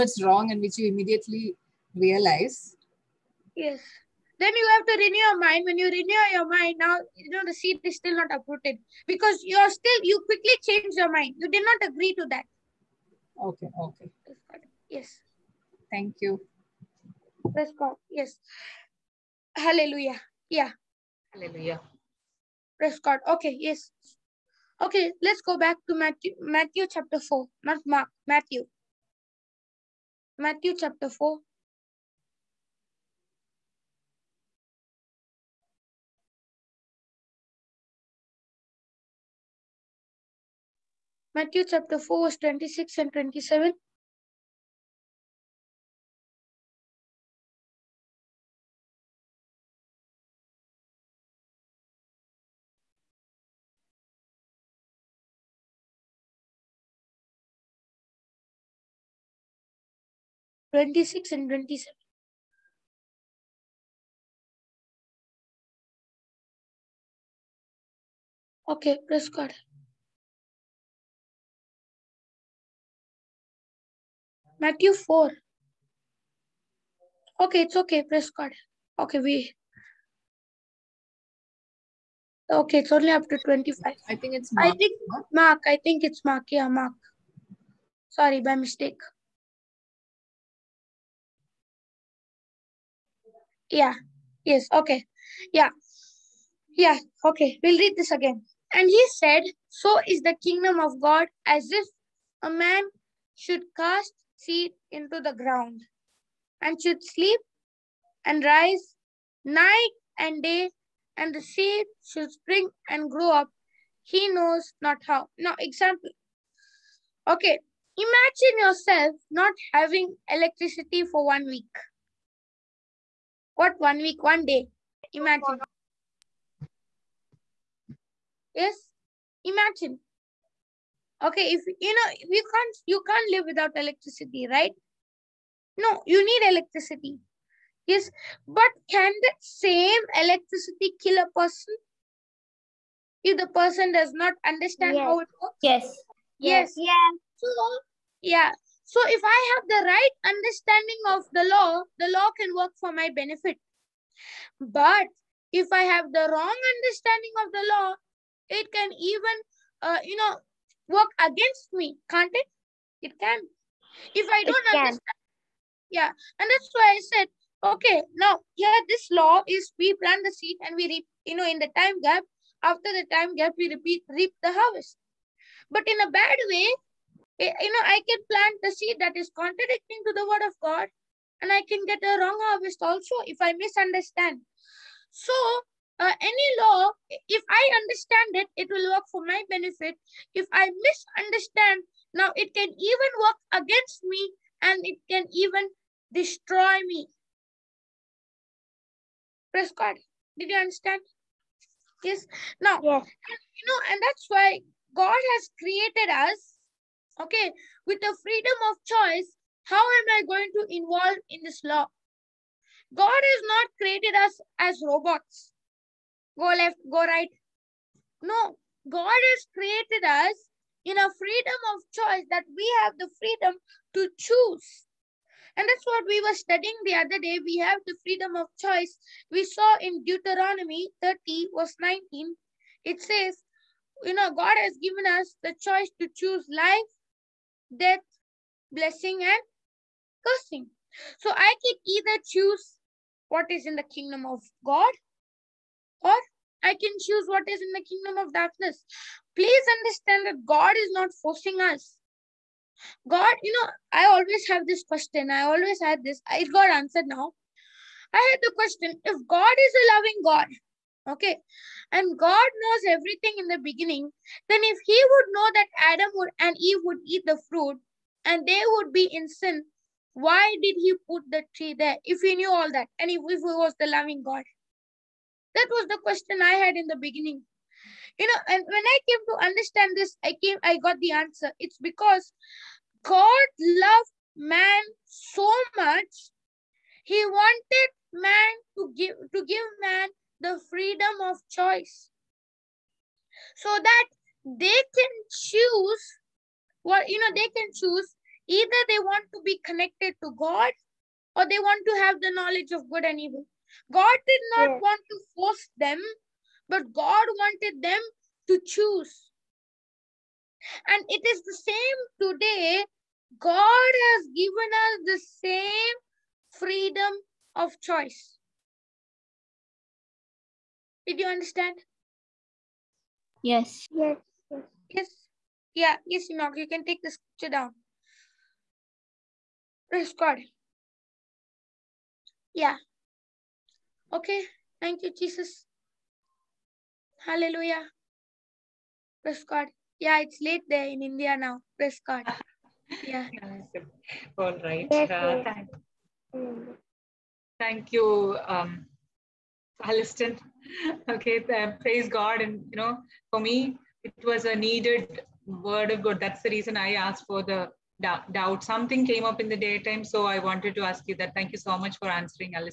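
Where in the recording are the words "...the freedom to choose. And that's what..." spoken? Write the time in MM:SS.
03:42.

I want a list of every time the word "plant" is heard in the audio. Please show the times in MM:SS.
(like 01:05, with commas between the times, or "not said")
02:49, 02:58.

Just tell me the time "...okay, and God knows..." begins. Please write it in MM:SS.
04:21.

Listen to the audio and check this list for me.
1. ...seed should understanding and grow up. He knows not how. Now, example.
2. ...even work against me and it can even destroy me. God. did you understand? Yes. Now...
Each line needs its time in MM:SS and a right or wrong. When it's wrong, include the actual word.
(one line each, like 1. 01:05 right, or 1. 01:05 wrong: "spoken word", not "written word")
1. 01:51 wrong: "spring", not "understanding"
2. 03:12 right.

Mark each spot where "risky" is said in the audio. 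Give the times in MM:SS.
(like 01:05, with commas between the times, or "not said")
not said.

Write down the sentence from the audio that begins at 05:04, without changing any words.
want to force them, but God wanted them to choose.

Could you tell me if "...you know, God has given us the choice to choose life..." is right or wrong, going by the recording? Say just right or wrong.
right.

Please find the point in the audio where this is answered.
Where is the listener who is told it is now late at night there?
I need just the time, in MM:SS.
05:41.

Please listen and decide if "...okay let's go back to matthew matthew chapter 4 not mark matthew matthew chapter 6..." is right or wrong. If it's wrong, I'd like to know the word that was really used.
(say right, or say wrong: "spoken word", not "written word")
wrong: "4", not "6".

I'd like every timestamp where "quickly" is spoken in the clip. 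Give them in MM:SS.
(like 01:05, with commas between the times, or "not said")
00:10.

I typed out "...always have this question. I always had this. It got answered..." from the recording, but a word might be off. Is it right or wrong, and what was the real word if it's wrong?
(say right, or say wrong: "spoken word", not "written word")
right.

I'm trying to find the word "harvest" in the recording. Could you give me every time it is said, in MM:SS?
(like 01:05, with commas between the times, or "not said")
02:54, 03:02.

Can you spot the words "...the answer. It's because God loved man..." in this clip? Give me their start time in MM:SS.
04:40.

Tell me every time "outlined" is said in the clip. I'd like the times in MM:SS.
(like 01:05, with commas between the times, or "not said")
not said.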